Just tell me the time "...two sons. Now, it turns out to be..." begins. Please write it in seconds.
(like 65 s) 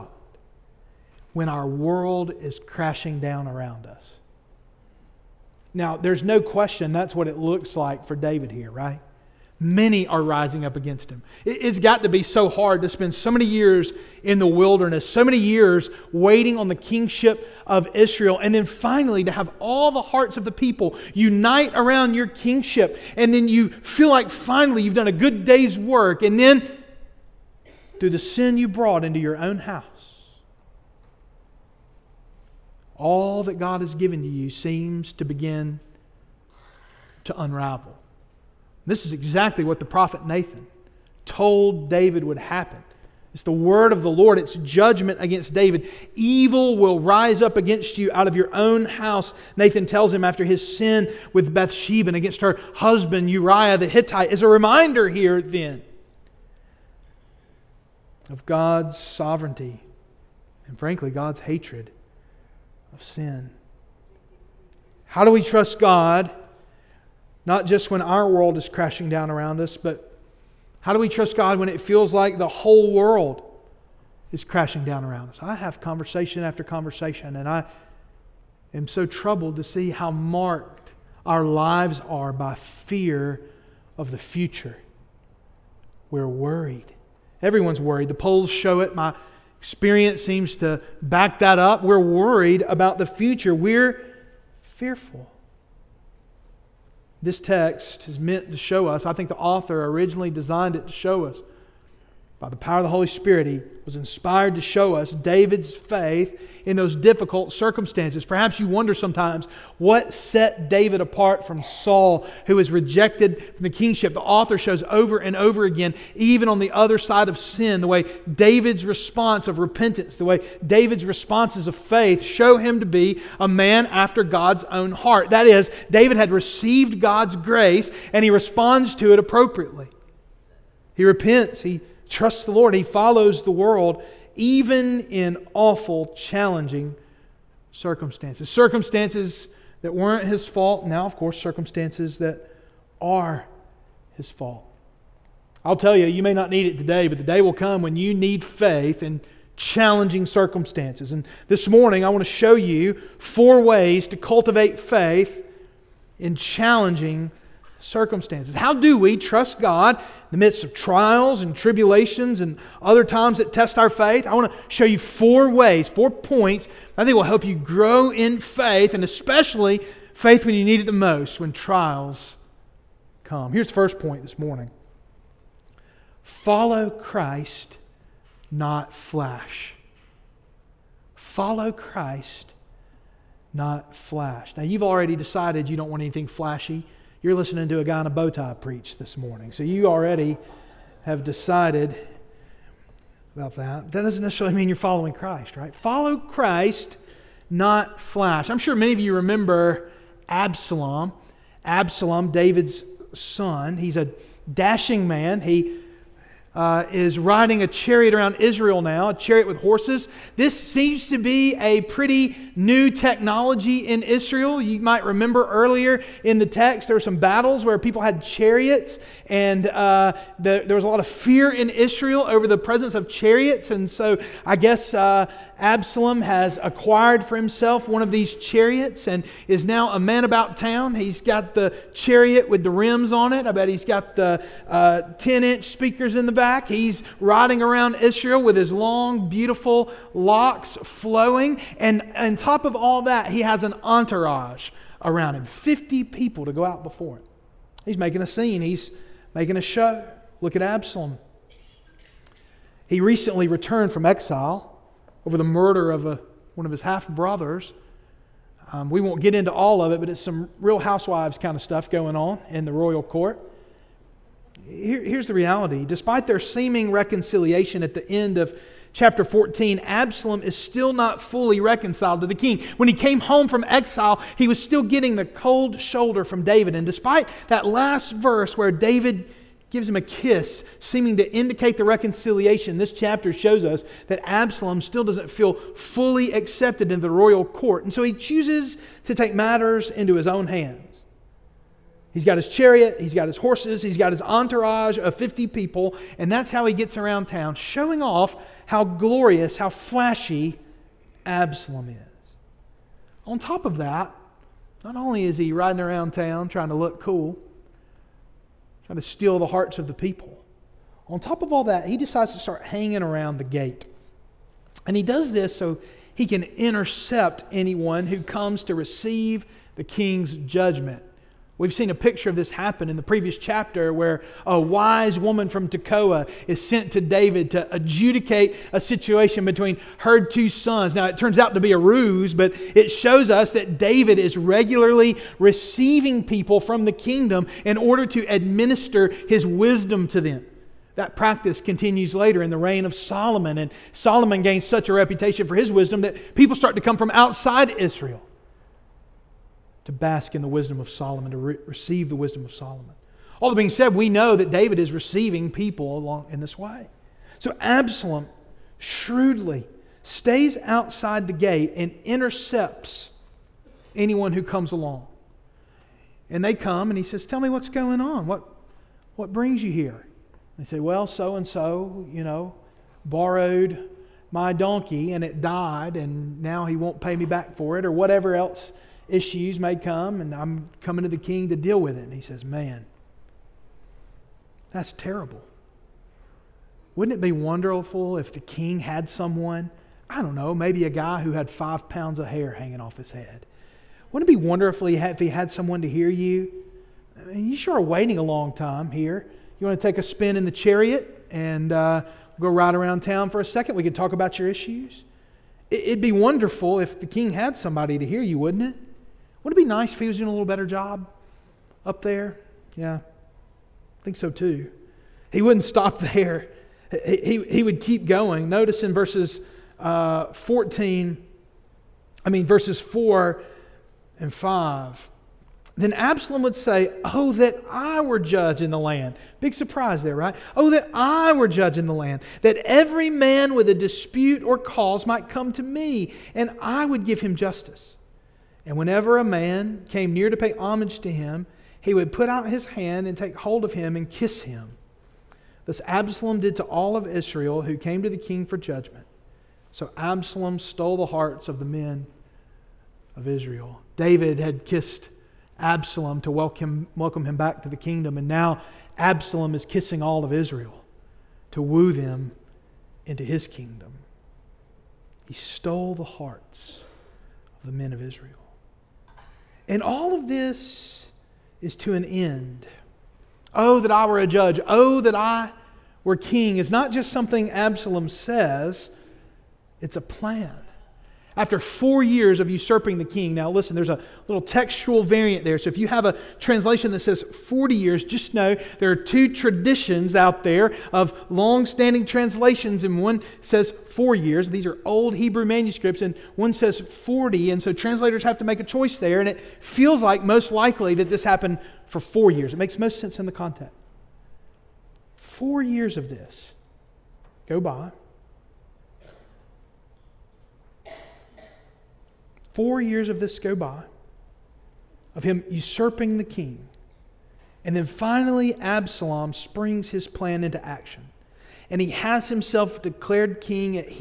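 330 s.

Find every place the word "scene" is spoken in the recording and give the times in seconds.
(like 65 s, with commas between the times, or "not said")
248 s.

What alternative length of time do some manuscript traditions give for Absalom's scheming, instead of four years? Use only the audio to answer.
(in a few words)
40 years.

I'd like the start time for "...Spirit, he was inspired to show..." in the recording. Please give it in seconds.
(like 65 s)
103 s.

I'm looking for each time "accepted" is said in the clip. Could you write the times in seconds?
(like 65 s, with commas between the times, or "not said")
286 s.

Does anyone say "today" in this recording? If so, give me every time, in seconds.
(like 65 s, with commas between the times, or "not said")
146 s.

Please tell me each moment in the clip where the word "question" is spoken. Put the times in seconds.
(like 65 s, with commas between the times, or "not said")
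6 s.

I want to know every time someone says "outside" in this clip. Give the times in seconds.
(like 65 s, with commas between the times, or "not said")
347 s, 360 s.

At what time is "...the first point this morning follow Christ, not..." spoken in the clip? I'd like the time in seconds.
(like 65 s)
173 s.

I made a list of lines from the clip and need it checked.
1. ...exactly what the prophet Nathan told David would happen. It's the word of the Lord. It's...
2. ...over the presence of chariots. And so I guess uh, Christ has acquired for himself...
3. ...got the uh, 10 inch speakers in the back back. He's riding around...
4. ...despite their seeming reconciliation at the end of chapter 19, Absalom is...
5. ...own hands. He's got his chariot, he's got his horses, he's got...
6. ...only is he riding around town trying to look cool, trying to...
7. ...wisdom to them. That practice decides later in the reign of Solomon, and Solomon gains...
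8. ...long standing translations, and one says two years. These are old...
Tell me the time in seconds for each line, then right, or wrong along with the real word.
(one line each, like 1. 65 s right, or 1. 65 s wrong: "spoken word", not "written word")
1. 39 s right
2. 222 s wrong: "Absalom", not "Christ"
3. 233 s right
4. 265 s wrong: "14", not "19"
5. 290 s right
6. 304 s right
7. 339 s wrong: "continues", not "decides"
8. 491 s wrong: "four", not "two".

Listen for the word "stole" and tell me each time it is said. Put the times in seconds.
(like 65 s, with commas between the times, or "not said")
450 s, 465 s.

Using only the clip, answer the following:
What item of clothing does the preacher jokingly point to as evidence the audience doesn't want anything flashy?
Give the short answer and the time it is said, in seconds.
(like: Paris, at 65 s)
bow tie, at 188 s.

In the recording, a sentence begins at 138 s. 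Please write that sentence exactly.
Circumstances that weren't his fault, now, of course, circumstances that are his fault.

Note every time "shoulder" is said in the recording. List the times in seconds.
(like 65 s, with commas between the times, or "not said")
275 s.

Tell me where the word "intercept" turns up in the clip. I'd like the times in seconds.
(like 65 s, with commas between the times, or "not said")
316 s, 362 s.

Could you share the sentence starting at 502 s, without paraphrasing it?
It makes most sense in the context.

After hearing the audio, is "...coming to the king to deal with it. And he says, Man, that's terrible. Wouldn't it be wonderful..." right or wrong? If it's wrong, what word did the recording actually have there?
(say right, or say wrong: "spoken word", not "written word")
right.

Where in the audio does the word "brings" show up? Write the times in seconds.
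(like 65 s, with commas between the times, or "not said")
369 s.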